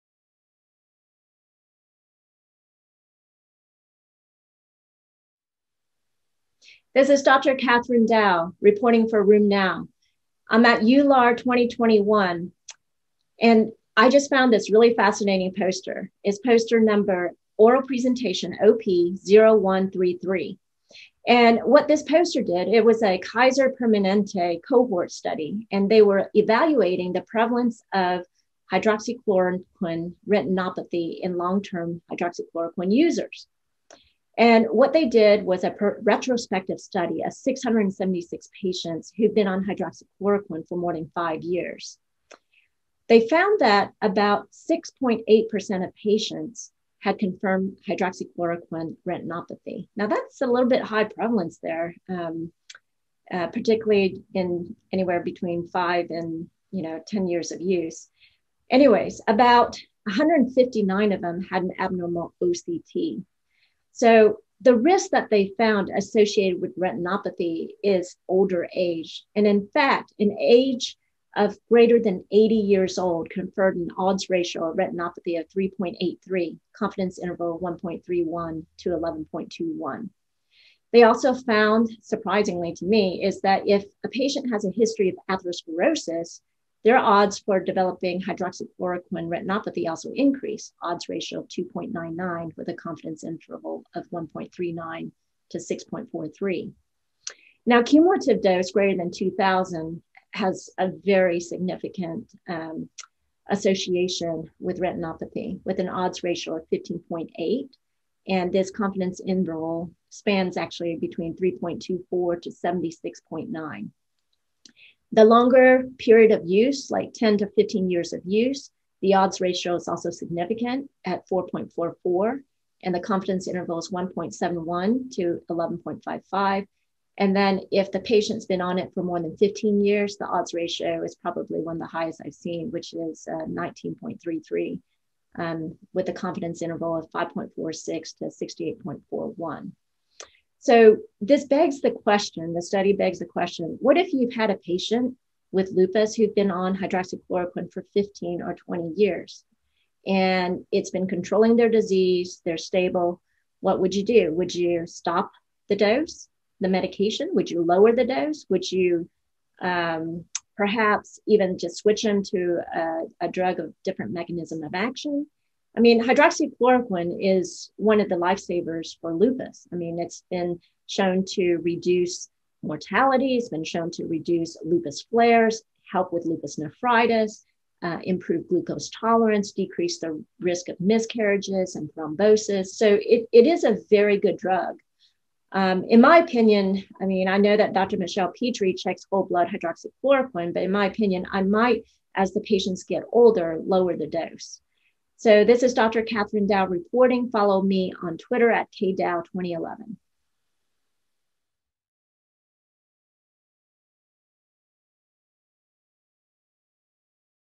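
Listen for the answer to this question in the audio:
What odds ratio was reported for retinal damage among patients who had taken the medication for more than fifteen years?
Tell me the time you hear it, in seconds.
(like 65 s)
133 s.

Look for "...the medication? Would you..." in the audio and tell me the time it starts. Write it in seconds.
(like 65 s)
156 s.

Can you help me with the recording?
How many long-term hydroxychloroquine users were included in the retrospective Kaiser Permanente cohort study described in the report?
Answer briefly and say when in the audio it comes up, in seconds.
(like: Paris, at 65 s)
676, at 37 s.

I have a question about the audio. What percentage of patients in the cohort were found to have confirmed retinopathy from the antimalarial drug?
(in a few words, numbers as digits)
6.8%.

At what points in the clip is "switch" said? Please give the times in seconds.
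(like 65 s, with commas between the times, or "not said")
161 s.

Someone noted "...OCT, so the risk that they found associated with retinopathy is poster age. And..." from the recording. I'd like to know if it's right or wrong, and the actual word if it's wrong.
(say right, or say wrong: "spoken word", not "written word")
wrong: "older", not "poster".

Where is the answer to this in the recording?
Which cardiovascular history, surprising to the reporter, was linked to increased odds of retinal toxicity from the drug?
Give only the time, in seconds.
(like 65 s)
85 s.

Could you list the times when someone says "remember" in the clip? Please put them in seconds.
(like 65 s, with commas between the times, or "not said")
not said.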